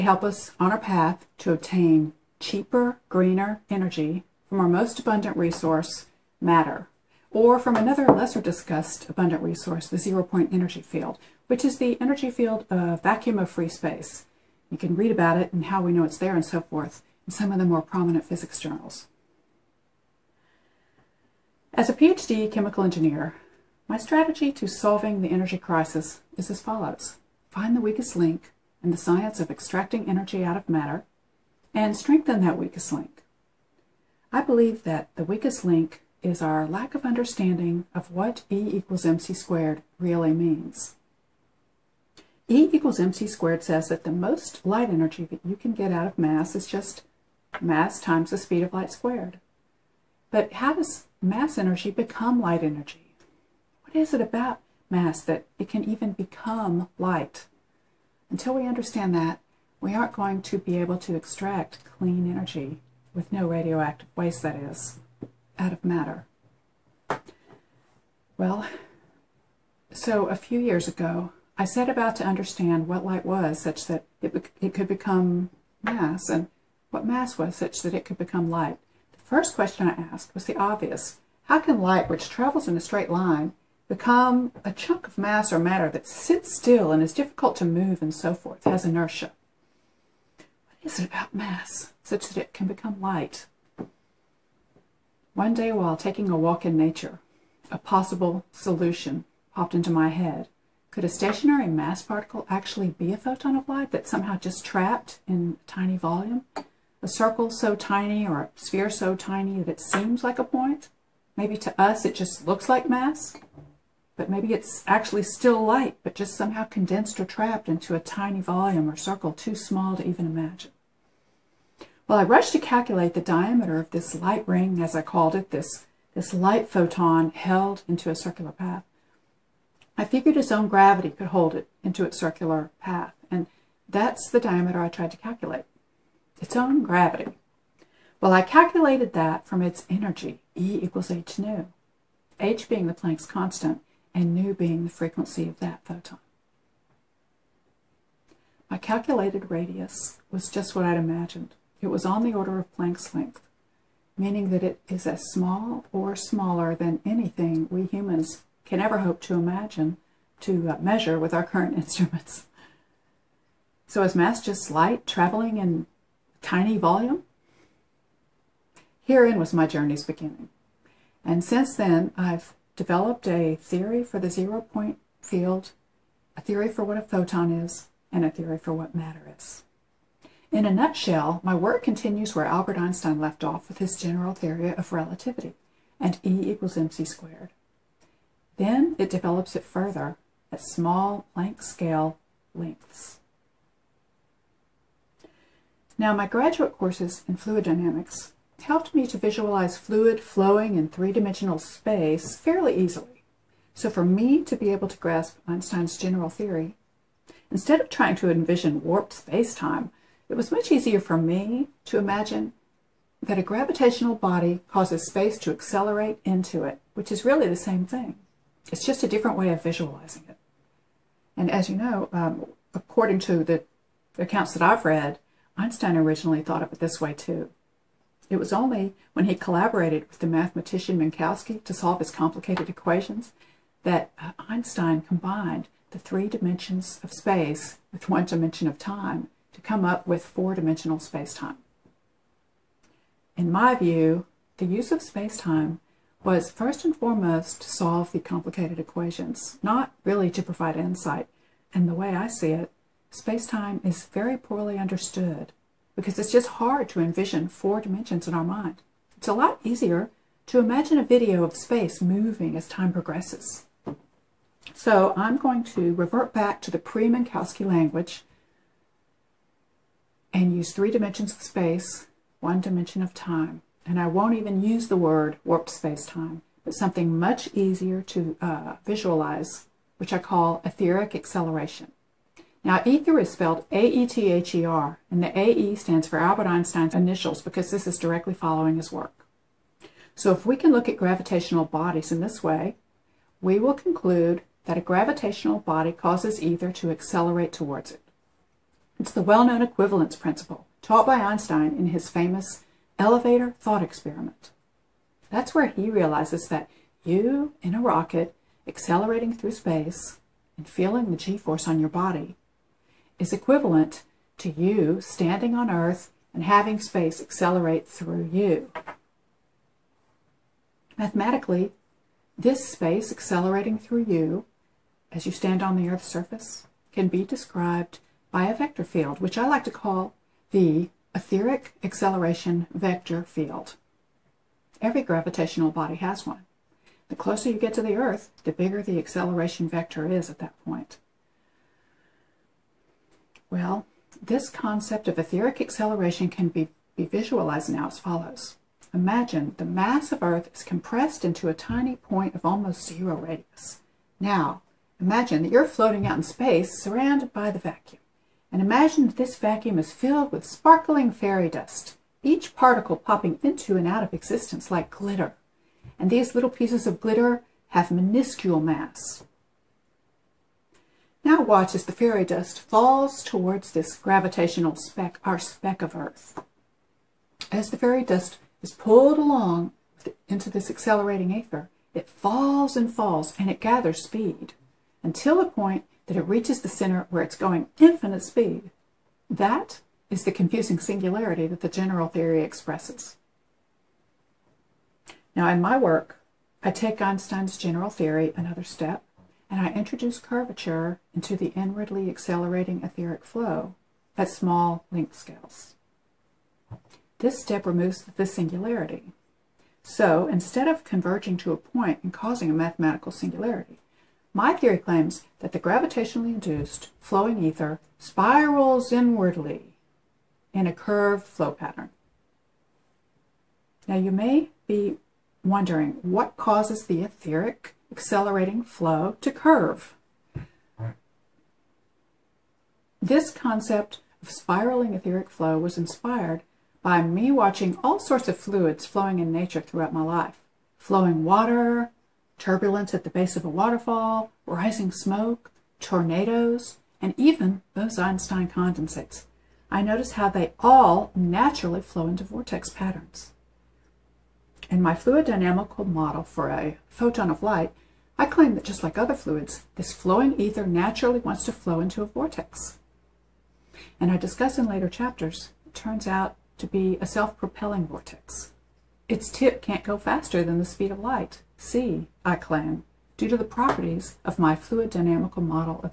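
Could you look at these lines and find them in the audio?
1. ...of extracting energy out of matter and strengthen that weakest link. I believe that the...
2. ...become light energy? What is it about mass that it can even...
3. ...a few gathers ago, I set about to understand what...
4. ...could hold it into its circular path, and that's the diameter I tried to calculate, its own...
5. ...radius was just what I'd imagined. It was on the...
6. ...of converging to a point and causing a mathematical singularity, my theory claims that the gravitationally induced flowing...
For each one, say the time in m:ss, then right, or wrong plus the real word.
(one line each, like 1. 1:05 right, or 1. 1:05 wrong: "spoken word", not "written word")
1. 0:29 right
2. 0:51 right
3. 1:10 wrong: "years", not "gathers"
4. 2:11 right
5. 2:29 right
6. 6:50 right.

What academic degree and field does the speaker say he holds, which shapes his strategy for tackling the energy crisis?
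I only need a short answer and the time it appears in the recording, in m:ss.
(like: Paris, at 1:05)
PhD chemical engineer, at 0:21.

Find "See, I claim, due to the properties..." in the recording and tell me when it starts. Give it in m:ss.
7:51.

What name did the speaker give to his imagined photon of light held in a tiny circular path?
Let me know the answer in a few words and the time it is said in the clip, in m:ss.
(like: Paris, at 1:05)
light ring, at 2:04.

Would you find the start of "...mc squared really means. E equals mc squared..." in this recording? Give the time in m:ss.
0:39.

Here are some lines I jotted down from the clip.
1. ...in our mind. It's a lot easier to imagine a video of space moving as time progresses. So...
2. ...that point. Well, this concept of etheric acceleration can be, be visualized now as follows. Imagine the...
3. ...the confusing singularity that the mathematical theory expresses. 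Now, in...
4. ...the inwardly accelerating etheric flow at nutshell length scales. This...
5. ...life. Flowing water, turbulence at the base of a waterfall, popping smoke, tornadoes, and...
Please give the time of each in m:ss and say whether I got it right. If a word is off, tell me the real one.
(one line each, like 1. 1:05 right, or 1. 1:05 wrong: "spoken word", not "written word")
1. 4:18 right
2. 5:40 right
3. 6:30 wrong: "general", not "mathematical"
4. 6:41 wrong: "small", not "nutshell"
5. 7:20 wrong: "rising", not "popping".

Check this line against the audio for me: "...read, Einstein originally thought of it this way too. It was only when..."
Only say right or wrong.
right.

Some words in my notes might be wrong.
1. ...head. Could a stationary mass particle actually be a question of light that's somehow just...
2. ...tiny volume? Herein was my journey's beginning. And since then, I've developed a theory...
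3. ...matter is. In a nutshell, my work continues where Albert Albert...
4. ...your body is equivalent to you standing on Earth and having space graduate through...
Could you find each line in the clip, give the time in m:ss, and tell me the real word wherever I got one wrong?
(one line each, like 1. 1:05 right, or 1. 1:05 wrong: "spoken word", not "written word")
1. 1:40 wrong: "photon", not "question"
2. 2:46 right
3. 2:58 wrong: "Einstein", not "Albert"
4. 5:11 wrong: "accelerate", not "graduate".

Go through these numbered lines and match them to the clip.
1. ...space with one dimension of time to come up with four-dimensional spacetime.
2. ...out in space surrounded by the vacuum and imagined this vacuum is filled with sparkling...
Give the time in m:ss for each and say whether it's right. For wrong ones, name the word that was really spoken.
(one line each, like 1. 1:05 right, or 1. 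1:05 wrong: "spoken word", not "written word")
1. 3:57 right
2. 5:56 right.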